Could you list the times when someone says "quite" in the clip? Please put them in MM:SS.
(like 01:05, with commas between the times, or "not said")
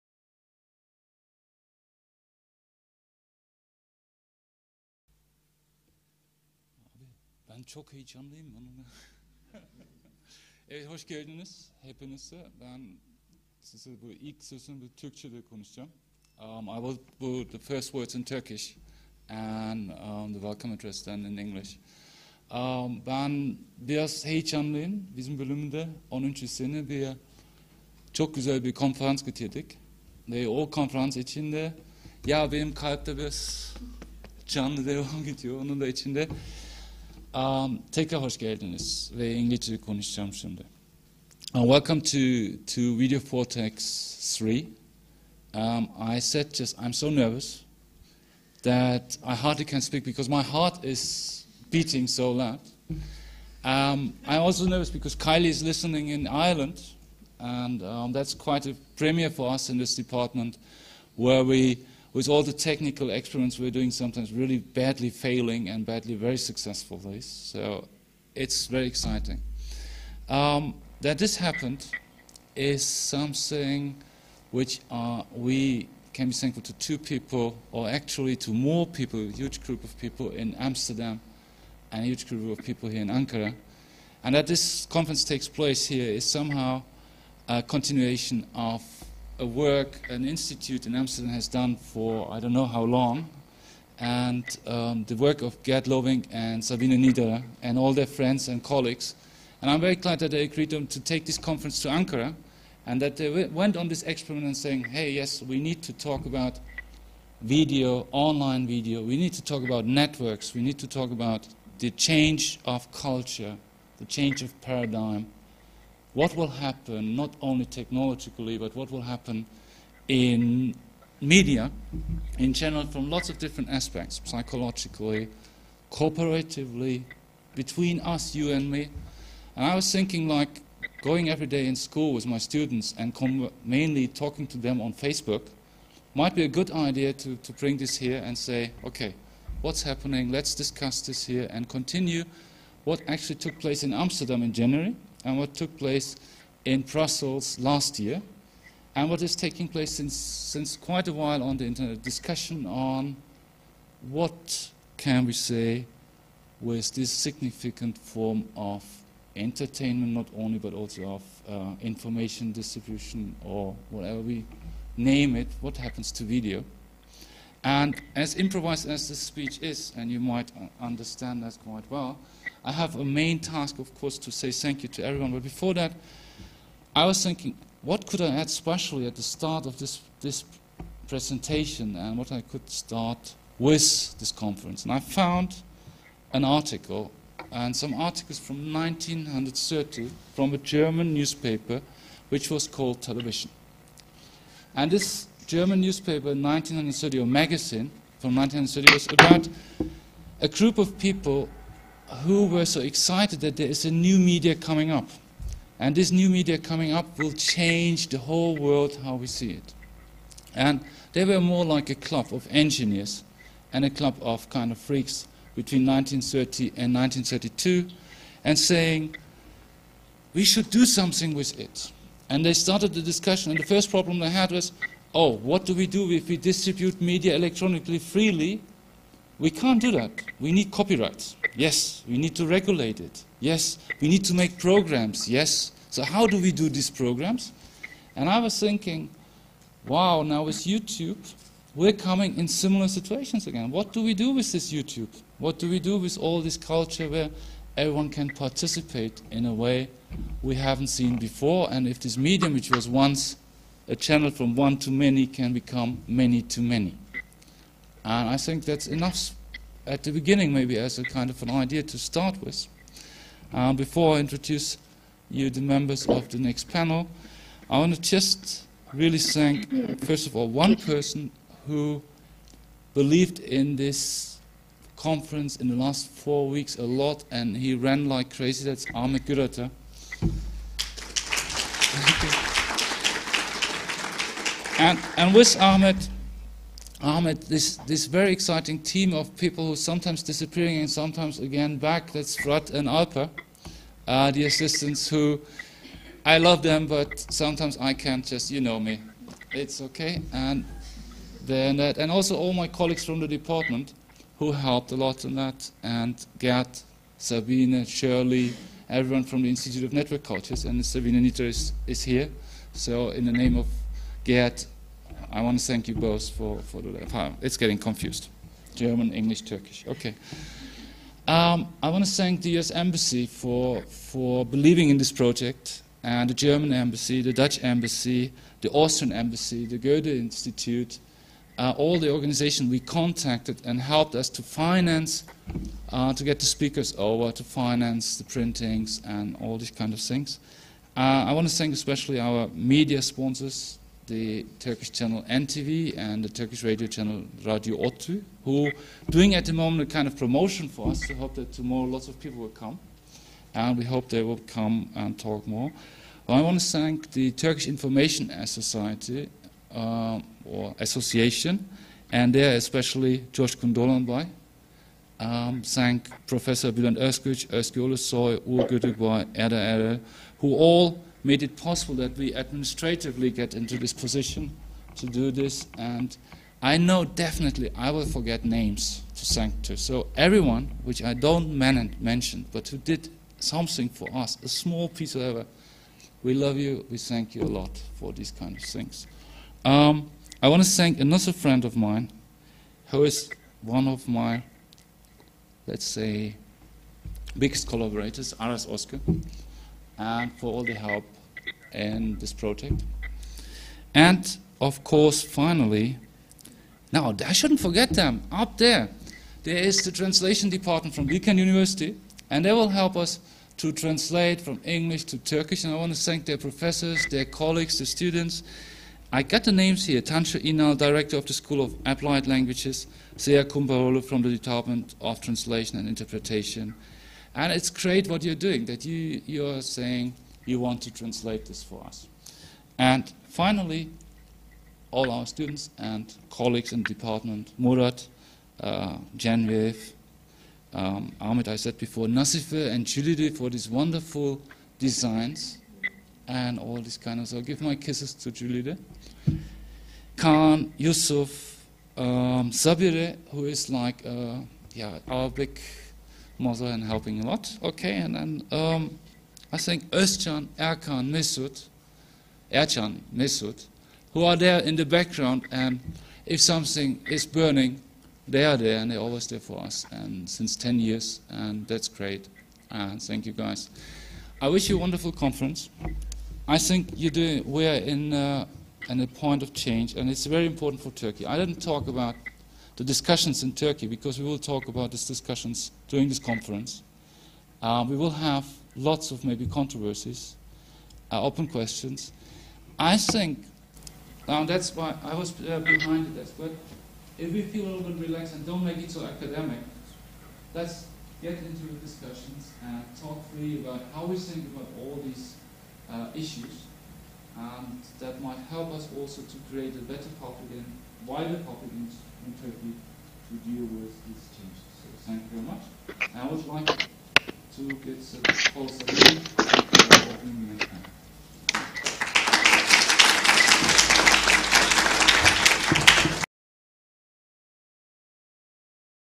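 00:58, 02:30, 02:51.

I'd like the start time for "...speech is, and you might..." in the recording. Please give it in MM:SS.
02:49.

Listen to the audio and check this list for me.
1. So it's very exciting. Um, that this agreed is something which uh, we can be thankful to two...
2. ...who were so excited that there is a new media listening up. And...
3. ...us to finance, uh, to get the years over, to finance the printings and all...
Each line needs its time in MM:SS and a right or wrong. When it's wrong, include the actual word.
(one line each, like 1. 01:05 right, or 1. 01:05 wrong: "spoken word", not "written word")
1. 01:07 wrong: "happened", not "agreed"
2. 03:22 wrong: "coming", not "listening"
3. 05:34 wrong: "speakers", not "years".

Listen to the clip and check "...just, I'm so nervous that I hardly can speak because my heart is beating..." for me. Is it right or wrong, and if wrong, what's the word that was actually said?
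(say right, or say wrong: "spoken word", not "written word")
right.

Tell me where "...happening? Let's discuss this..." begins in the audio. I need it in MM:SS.
02:19.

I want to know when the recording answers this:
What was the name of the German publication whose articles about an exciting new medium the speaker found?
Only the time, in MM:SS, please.
03:13.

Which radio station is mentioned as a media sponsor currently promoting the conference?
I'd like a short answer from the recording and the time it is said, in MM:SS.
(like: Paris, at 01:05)
Radio ODTÜ, at 05:47.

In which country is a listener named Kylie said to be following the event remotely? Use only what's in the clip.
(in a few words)
Ireland.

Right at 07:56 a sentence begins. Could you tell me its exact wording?
I think you do, we're in, uh, in a point of change, and it's very important for Turkey.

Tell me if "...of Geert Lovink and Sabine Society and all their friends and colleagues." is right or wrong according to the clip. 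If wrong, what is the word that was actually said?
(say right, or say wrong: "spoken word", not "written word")
wrong: "Niederer", not "Society".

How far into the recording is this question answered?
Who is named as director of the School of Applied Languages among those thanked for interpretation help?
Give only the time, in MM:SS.
07:00.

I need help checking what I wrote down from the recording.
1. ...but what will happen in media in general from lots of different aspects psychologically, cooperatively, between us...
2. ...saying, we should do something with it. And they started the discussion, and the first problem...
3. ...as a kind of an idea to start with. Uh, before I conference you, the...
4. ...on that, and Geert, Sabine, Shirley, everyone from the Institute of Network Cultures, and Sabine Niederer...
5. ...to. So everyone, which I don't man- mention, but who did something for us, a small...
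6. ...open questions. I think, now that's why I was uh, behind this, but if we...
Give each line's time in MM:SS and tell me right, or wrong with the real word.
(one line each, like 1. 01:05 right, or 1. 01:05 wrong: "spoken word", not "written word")
1. 01:58 right
2. 03:38 right
3. 04:20 wrong: "introduce", not "conference"
4. 05:05 right
5. 06:19 right
6. 08:11 right.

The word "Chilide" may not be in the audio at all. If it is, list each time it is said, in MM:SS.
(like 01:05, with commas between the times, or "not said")
07:22, 07:28.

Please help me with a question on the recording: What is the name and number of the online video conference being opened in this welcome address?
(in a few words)
Video Vortex 3.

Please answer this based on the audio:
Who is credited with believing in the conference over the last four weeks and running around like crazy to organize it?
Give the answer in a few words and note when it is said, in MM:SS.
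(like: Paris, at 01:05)
Ahmed Gürata, at 04:38.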